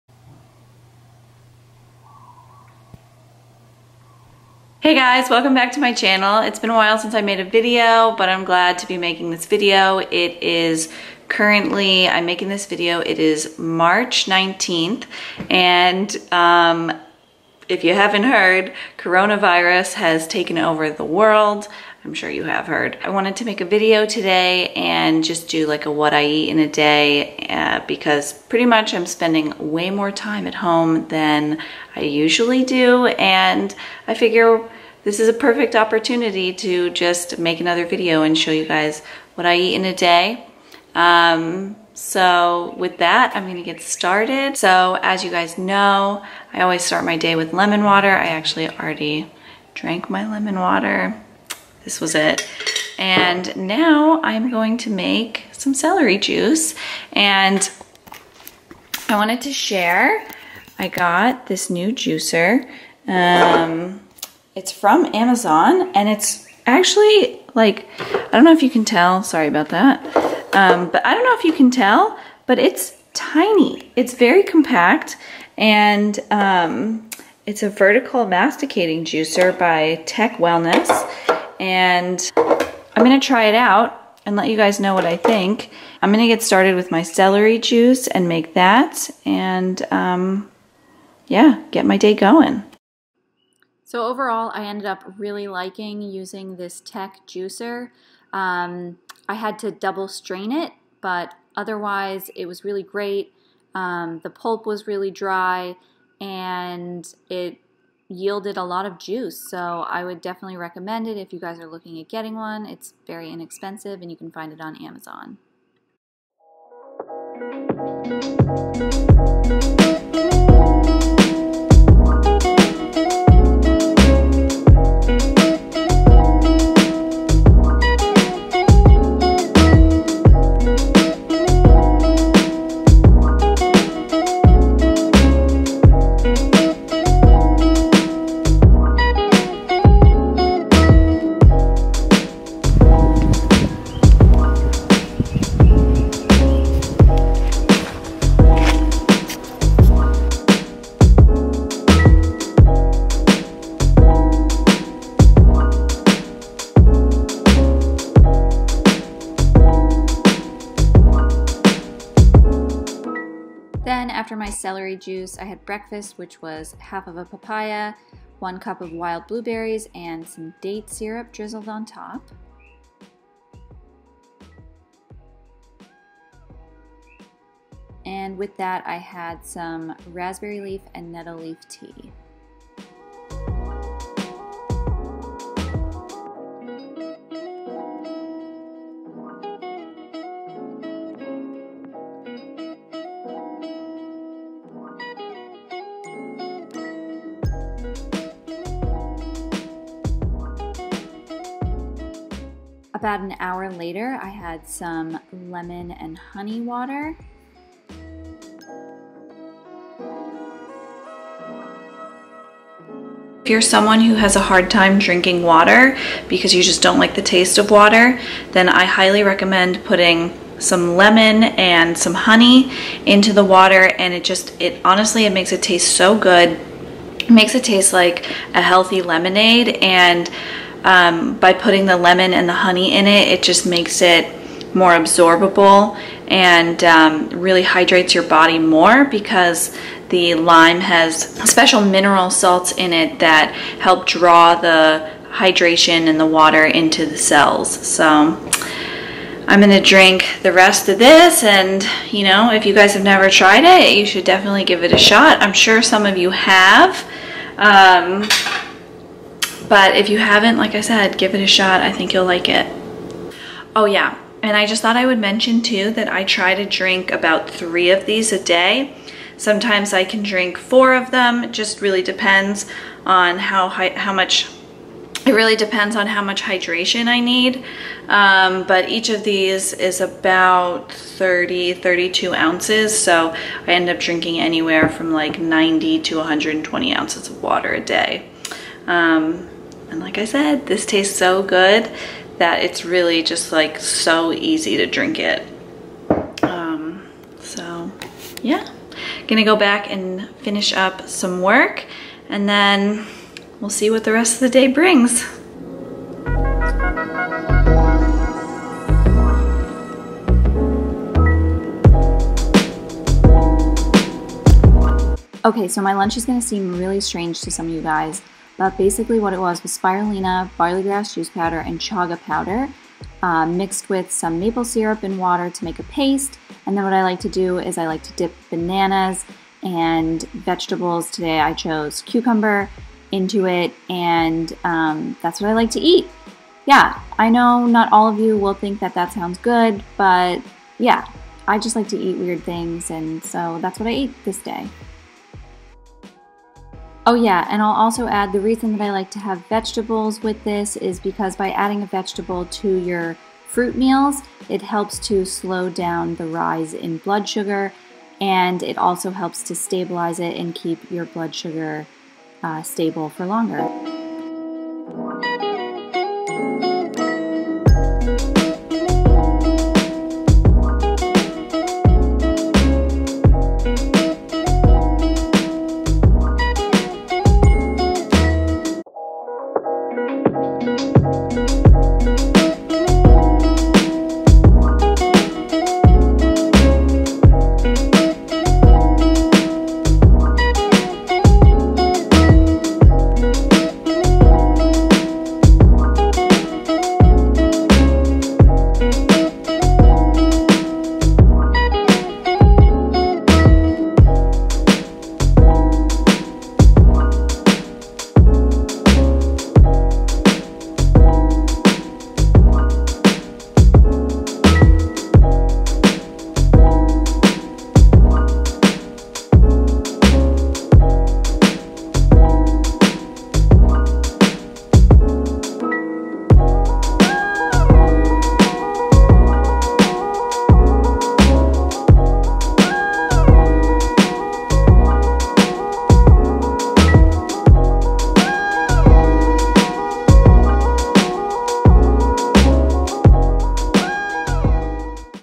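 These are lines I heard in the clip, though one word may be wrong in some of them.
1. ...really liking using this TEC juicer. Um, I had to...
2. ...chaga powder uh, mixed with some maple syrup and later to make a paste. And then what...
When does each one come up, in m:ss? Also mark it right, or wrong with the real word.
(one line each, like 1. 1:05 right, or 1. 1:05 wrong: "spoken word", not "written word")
1. 1:35 right
2. 5:21 wrong: "water", not "later".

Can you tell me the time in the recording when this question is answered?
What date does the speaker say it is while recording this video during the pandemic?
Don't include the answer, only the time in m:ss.
0:13.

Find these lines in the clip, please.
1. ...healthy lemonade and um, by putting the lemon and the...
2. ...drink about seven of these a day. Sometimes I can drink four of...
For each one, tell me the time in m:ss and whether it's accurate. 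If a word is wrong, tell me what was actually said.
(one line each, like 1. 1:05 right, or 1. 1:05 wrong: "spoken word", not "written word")
1. 3:48 right
2. 4:26 wrong: "three", not "seven".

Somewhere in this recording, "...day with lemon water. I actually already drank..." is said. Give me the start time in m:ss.
0:47.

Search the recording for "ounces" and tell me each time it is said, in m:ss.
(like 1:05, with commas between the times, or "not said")
4:42, 4:46.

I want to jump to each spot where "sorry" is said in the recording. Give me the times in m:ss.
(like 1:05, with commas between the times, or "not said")
1:09.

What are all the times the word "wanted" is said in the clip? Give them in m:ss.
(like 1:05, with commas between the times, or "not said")
0:23, 0:59.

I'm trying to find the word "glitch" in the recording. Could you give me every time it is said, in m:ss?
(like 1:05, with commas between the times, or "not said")
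not said.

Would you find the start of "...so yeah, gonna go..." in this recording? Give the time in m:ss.
4:57.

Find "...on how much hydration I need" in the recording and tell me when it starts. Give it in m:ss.
4:35.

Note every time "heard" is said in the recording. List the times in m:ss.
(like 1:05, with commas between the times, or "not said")
0:18, 0:22.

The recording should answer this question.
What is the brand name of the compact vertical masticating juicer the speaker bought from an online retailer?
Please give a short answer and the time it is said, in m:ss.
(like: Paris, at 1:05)
TEC Wellness, at 1:20.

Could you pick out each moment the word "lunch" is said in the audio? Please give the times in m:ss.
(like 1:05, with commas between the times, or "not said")
5:15.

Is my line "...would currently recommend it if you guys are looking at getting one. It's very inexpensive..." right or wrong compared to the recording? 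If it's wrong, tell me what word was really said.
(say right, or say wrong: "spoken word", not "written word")
wrong: "definitely", not "currently".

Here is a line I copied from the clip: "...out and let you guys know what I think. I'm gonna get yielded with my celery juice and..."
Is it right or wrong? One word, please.
wrong.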